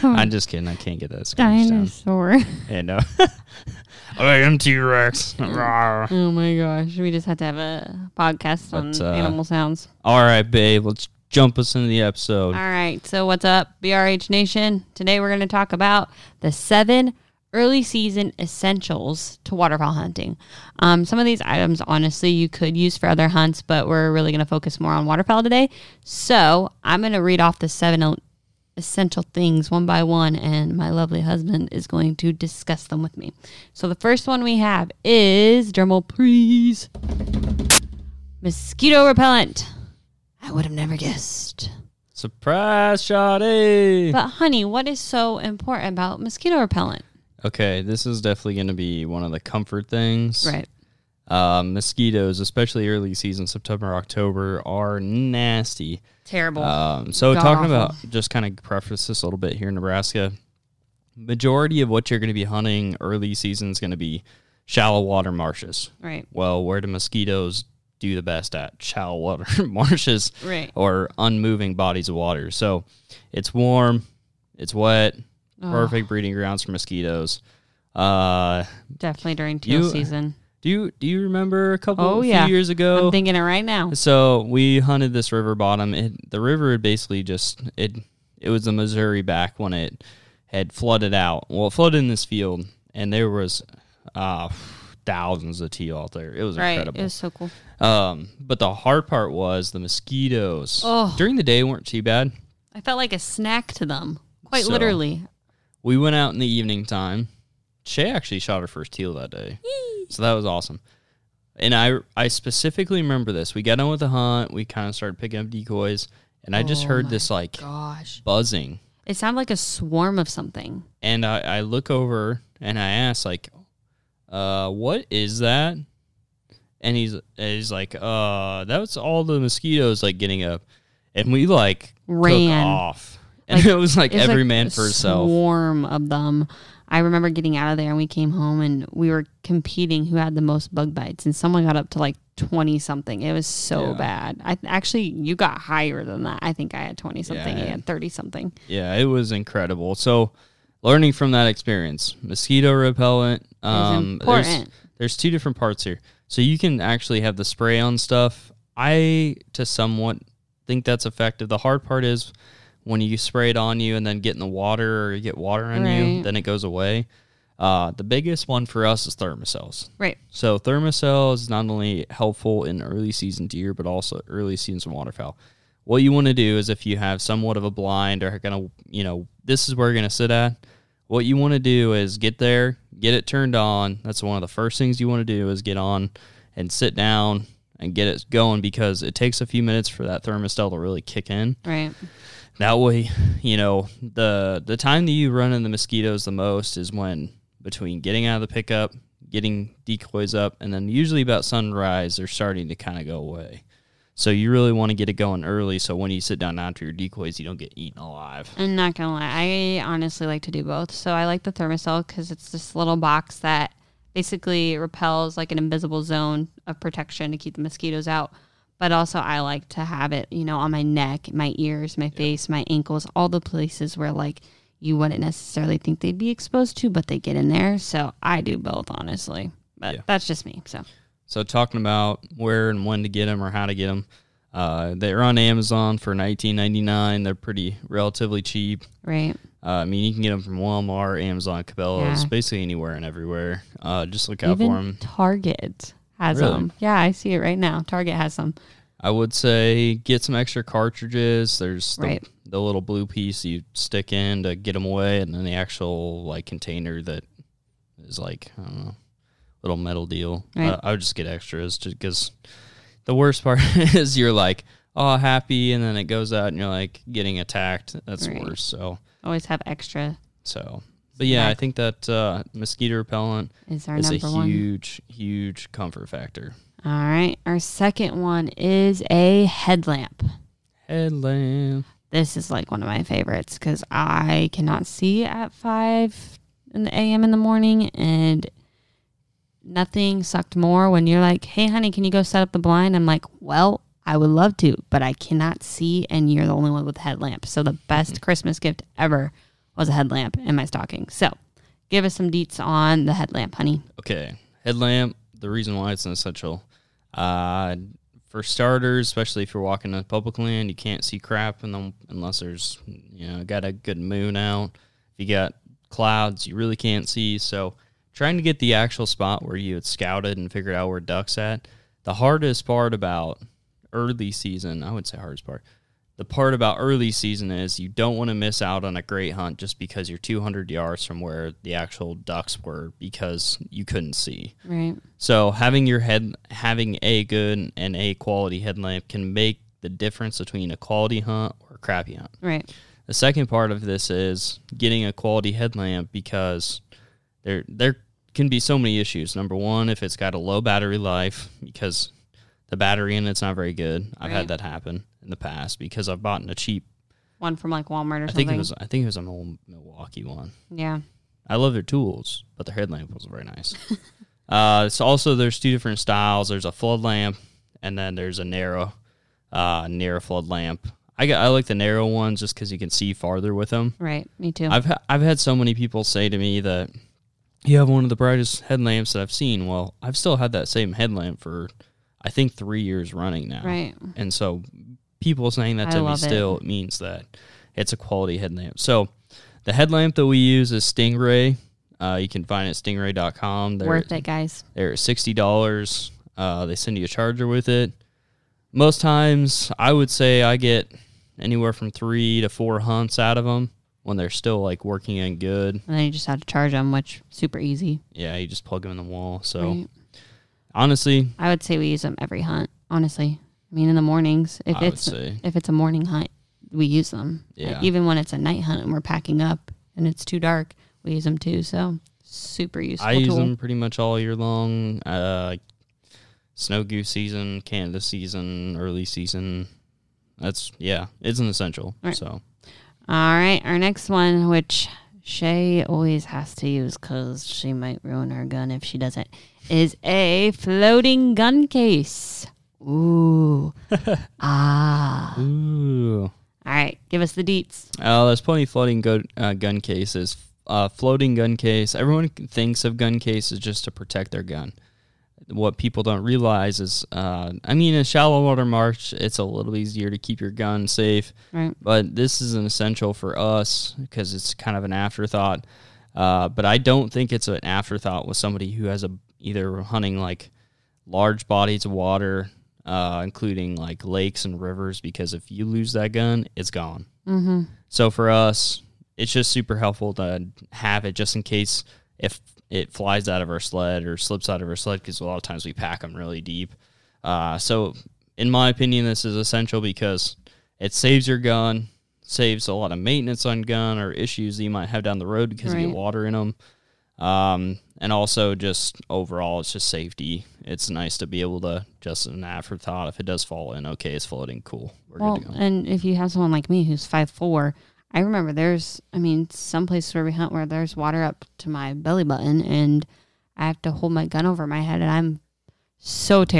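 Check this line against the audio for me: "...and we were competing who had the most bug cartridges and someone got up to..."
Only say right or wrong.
wrong.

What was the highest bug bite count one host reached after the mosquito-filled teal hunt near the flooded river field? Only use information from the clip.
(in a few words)
30 something.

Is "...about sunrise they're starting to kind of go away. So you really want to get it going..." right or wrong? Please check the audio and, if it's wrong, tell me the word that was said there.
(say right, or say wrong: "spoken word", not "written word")
right.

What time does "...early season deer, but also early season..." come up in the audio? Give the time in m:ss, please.
2:52.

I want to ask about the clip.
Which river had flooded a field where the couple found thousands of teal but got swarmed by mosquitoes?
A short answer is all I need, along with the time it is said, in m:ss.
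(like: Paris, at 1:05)
Missouri, at 1:28.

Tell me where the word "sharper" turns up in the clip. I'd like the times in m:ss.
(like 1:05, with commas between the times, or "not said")
not said.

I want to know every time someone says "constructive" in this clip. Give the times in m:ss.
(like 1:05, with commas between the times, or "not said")
not said.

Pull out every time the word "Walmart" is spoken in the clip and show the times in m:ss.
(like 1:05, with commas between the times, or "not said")
4:00, 5:57.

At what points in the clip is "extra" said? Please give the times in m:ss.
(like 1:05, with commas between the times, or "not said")
4:10, 4:21, 4:29.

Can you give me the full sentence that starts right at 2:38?
I to somewhat think that's effective.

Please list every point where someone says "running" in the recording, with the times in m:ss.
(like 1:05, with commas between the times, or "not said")
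6:23.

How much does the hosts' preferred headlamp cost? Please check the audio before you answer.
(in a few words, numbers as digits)
$60.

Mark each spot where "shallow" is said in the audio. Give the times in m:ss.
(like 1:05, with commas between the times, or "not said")
1:04, 1:08, 7:38.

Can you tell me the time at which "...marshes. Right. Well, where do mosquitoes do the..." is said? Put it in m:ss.
1:05.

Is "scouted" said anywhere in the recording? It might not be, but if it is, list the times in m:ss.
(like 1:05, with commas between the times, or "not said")
5:19.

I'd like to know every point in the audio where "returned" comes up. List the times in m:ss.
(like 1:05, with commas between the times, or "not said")
not said.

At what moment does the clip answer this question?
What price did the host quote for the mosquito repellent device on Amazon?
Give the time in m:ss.
3:56.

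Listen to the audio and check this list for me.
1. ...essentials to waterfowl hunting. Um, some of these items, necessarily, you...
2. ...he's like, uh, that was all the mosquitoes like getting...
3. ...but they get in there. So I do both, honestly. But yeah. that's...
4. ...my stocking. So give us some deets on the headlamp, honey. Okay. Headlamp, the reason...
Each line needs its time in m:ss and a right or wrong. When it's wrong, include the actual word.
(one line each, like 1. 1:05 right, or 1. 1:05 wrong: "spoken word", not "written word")
1. 0:18 wrong: "honestly", not "necessarily"
2. 2:07 right
3. 3:46 right
4. 5:00 right.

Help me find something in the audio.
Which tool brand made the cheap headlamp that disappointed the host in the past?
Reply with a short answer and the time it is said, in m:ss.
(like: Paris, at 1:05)
Milwaukee, at 5:59.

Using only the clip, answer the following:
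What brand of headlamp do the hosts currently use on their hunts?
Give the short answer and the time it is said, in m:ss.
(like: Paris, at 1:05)
Stingray, at 6:30.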